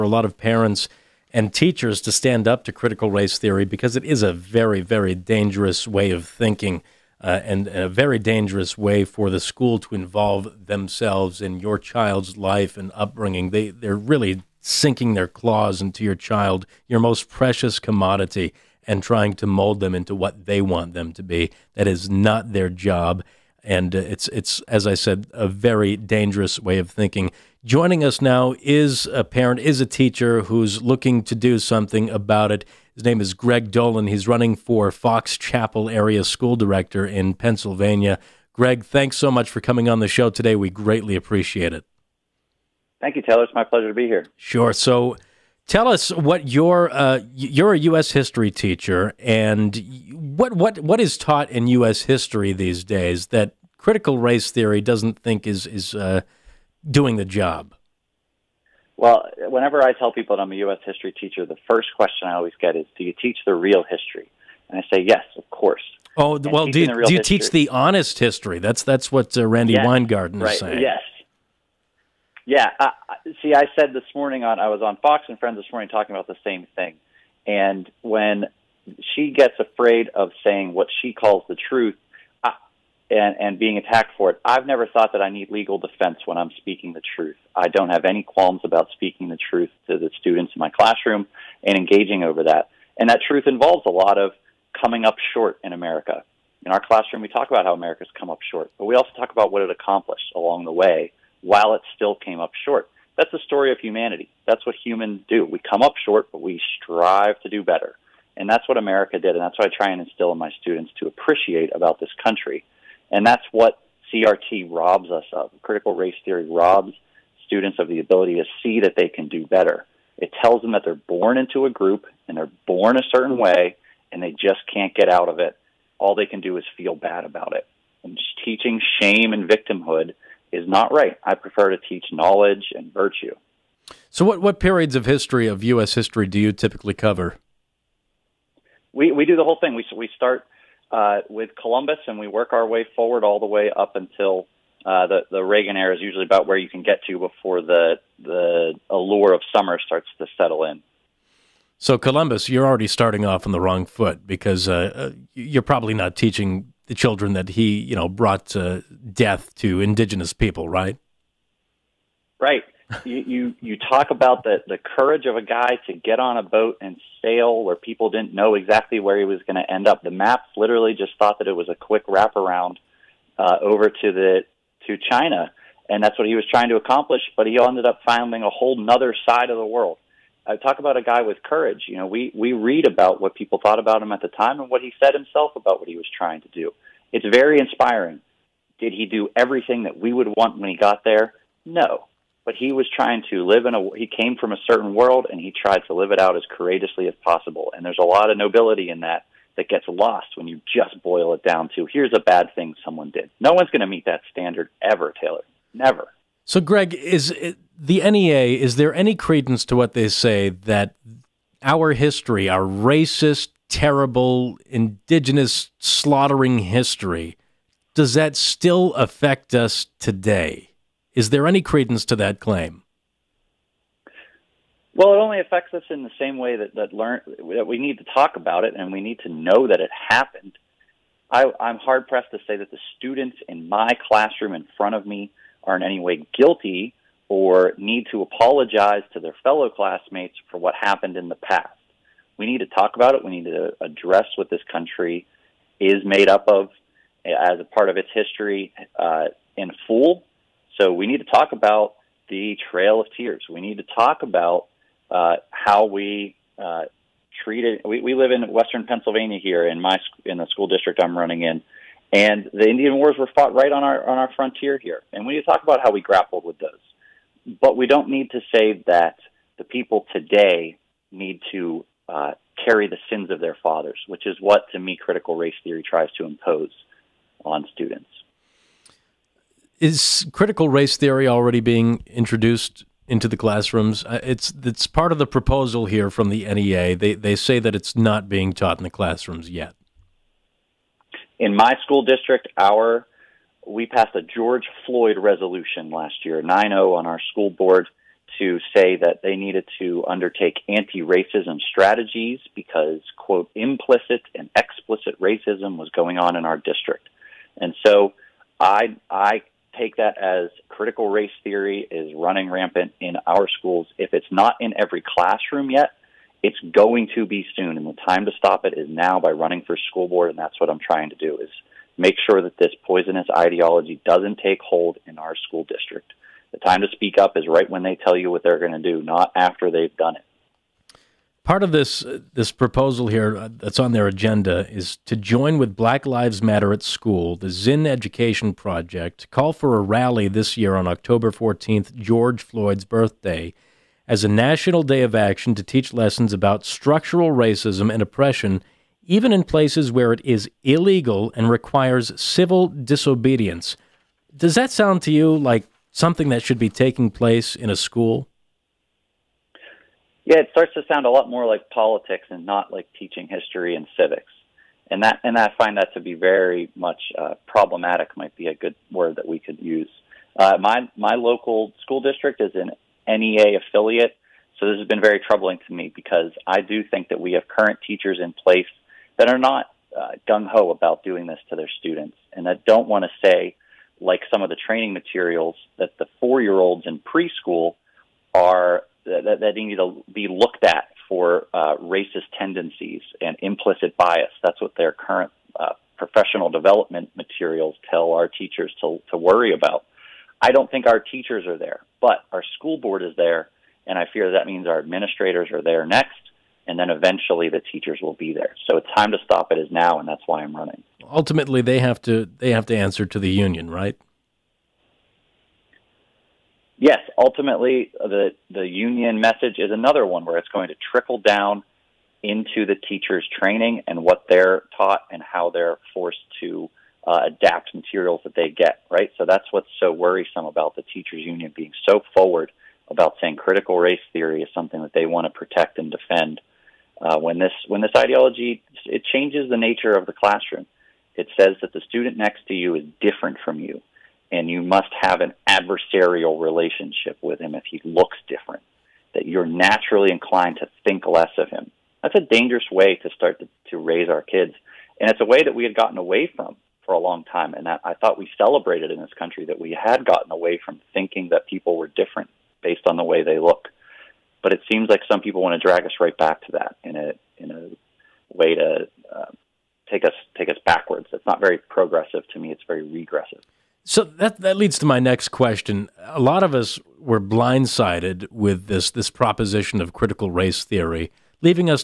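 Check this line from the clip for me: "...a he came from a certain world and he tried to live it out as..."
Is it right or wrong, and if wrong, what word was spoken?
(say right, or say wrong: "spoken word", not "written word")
right.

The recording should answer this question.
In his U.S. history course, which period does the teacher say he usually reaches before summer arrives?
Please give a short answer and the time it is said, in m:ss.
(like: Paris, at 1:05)
The Reagan era, at 2:25.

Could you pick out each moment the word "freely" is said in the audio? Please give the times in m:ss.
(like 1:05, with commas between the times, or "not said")
not said.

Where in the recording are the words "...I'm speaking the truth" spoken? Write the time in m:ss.
1:26.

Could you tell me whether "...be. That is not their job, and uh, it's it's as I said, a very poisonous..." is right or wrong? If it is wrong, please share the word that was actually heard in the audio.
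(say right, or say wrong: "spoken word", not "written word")
wrong: "dangerous", not "poisonous".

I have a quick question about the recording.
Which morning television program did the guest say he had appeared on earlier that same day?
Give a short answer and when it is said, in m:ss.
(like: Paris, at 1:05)
Fox and Friends, at 1:14.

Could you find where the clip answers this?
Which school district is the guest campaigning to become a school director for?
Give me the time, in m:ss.
0:34.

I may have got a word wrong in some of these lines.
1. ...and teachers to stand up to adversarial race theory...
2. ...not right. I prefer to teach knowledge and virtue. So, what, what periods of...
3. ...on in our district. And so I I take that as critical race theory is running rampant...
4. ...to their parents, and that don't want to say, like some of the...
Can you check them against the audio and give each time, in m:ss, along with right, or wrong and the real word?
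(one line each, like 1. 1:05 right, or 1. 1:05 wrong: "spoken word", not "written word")
1. 0:01 wrong: "critical", not "adversarial"
2. 2:10 right
3. 5:06 right
4. 6:21 wrong: "students", not "parents".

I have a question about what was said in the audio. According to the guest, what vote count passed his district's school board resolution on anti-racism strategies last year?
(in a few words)
9-0.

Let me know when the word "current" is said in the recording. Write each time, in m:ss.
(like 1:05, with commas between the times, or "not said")
6:17, 6:34.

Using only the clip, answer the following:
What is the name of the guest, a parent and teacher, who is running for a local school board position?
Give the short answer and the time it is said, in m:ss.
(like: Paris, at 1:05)
Greg Dolan, at 0:33.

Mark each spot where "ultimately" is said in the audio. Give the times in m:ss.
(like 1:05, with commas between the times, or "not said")
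6:51, 6:57.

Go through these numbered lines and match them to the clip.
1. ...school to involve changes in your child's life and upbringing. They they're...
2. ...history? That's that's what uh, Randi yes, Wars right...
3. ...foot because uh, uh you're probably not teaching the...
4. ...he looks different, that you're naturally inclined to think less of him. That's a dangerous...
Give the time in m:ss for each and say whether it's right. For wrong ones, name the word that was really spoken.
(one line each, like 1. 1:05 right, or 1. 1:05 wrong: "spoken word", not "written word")
1. 0:09 wrong: "themselves", not "changes"
2. 1:08 wrong: "Weingarten", not "Wars"
3. 2:33 right
4. 7:27 right.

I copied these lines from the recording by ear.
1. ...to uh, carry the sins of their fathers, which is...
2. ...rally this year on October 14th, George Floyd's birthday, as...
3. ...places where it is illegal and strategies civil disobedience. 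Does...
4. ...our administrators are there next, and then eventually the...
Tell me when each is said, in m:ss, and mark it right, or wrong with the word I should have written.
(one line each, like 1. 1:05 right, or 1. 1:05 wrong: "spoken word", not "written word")
1. 4:31 right
2. 5:39 right
3. 5:49 wrong: "requires", not "strategies"
4. 6:44 right.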